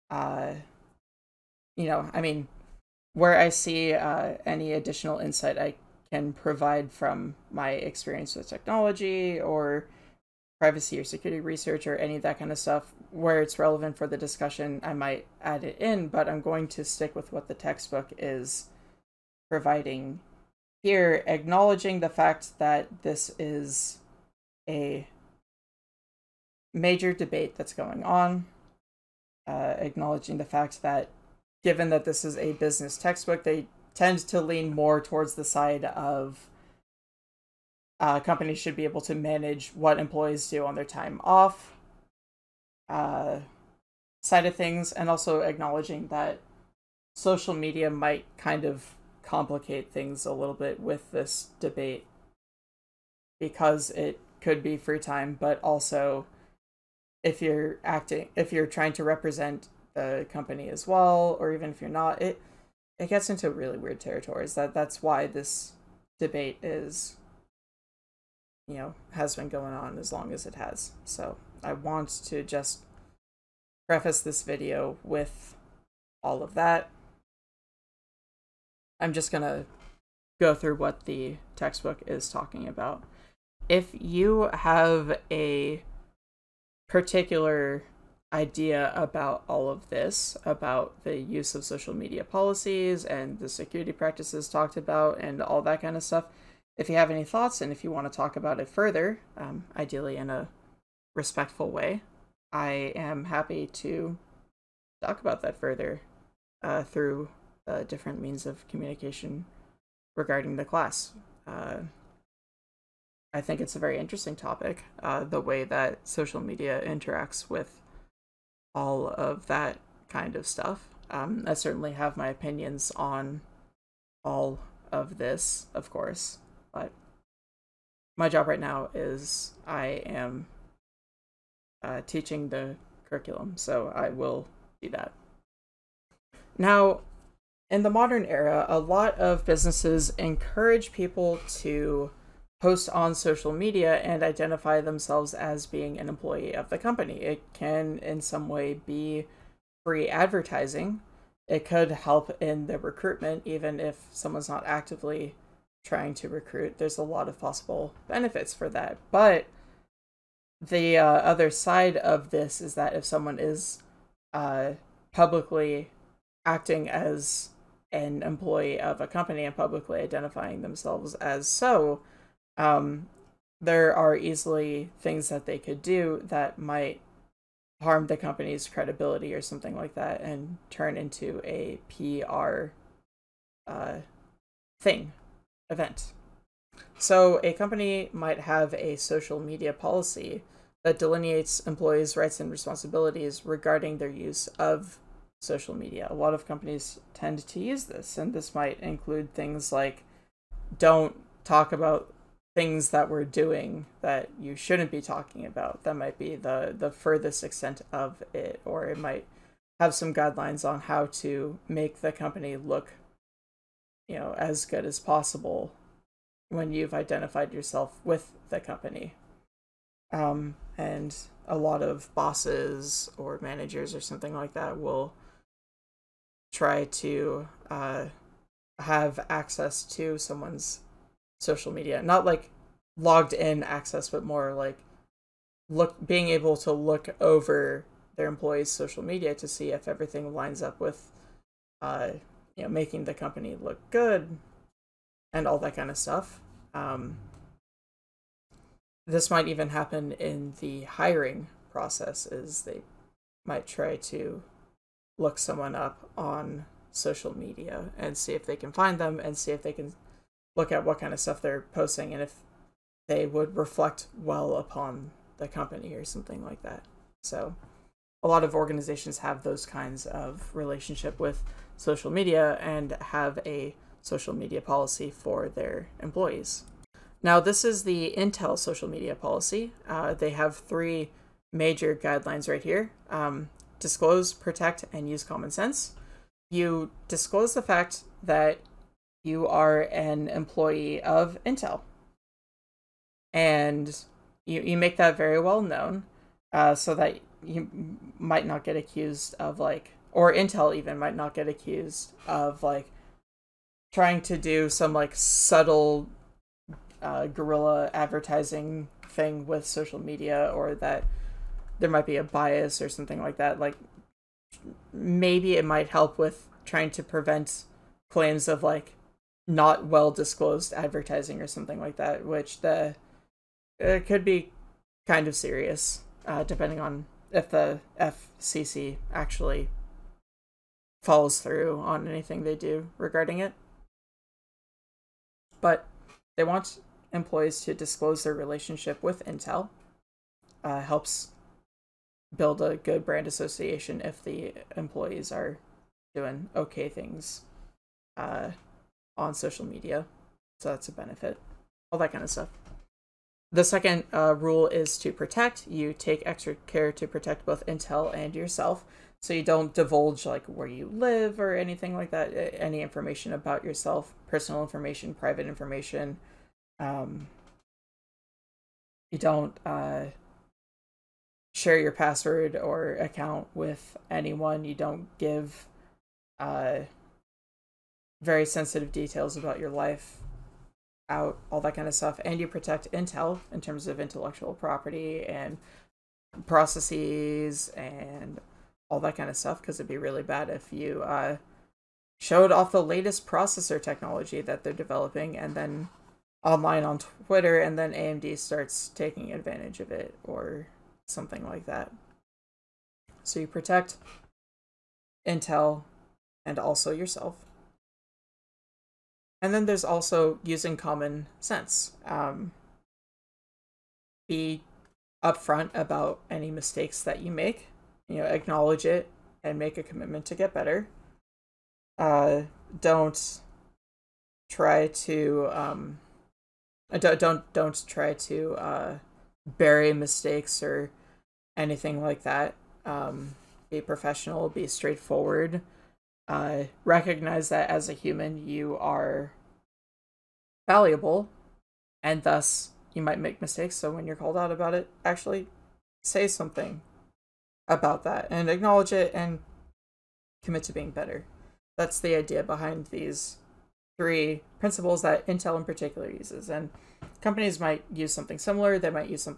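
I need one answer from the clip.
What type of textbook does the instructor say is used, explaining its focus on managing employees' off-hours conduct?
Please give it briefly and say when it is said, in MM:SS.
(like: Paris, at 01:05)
Business textbook, at 00:32.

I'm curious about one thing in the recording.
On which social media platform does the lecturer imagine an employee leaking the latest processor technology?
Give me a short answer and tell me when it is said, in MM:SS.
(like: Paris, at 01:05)
Twitter, at 06:37.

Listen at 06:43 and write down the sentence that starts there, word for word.
So you protect Intel and also yourself.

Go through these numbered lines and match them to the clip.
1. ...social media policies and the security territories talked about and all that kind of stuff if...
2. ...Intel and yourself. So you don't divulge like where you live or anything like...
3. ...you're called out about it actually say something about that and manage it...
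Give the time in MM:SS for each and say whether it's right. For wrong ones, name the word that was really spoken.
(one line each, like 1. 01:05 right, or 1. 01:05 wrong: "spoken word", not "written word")
1. 01:31 wrong: "practices", not "territories"
2. 05:57 right
3. 07:24 wrong: "acknowledge", not "manage".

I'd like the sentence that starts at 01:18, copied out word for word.
I'm just going to go through what the textbook is talking about.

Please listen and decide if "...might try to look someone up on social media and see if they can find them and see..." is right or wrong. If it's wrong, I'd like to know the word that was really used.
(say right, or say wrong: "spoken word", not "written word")
right.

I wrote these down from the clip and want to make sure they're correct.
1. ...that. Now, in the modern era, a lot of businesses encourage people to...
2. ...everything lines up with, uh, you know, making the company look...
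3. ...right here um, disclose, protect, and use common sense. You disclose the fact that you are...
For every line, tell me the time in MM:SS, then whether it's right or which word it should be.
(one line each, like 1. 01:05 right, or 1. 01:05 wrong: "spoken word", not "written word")
1. 02:14 right
2. 03:59 right
3. 04:42 right.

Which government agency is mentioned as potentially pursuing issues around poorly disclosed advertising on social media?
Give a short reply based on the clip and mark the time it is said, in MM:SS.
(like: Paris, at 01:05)
FCC, at 05:27.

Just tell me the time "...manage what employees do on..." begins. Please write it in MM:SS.
00:39.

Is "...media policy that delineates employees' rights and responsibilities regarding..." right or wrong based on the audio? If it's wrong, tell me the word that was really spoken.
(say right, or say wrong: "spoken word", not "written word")
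right.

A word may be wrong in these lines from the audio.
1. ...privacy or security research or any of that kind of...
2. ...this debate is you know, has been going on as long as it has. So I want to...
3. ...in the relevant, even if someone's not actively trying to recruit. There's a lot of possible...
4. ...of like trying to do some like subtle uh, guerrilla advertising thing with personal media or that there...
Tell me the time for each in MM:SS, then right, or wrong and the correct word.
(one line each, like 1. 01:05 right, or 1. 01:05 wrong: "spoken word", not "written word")
1. 00:10 right
2. 01:05 right
3. 02:32 wrong: "recruitment", not "relevant"
4. 05:02 wrong: "social", not "personal".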